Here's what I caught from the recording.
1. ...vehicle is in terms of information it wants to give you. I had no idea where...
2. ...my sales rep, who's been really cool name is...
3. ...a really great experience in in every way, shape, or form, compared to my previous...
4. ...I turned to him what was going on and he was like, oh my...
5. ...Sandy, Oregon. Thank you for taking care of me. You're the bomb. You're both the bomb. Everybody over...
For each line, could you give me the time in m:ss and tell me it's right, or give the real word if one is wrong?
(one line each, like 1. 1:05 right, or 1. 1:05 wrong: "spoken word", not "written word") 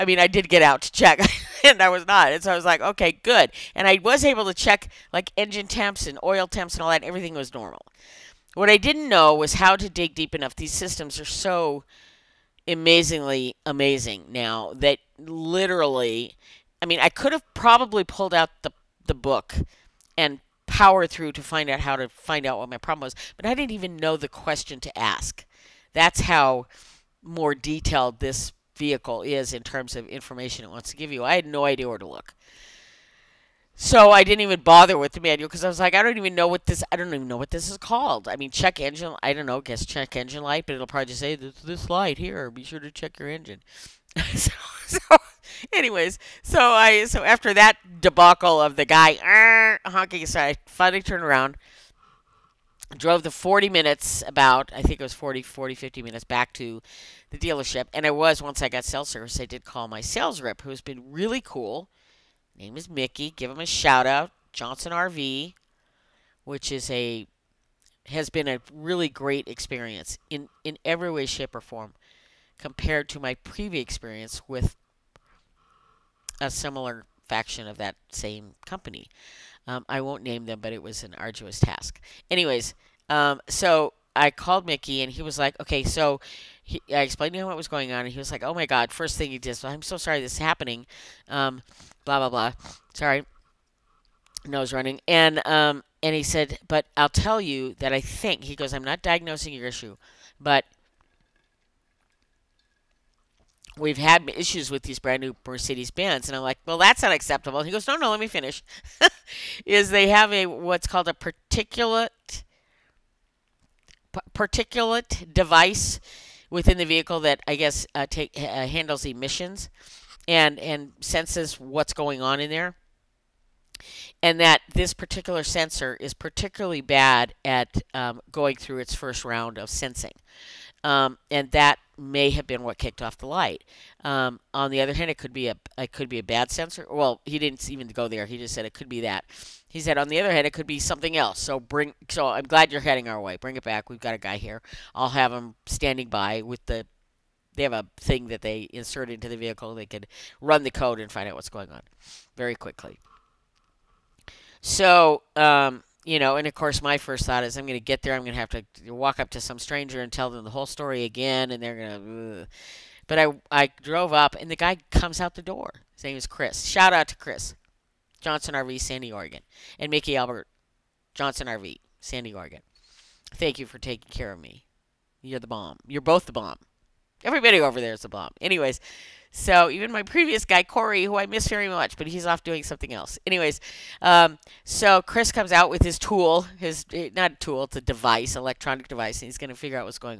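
1. 0:28 right
2. 0:59 right
3. 1:08 right
4. 1:26 wrong: "explained", not "turned"
5. 2:51 right.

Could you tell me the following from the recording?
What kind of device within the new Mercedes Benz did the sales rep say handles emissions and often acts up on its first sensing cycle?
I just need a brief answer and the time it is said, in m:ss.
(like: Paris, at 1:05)
particulate device, at 1:54.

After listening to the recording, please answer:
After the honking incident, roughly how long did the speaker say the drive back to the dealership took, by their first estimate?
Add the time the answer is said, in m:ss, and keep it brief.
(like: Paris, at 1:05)
40 minutes, at 0:53.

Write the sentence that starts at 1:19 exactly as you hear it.
Um, I won't name them, but it was an arduous task.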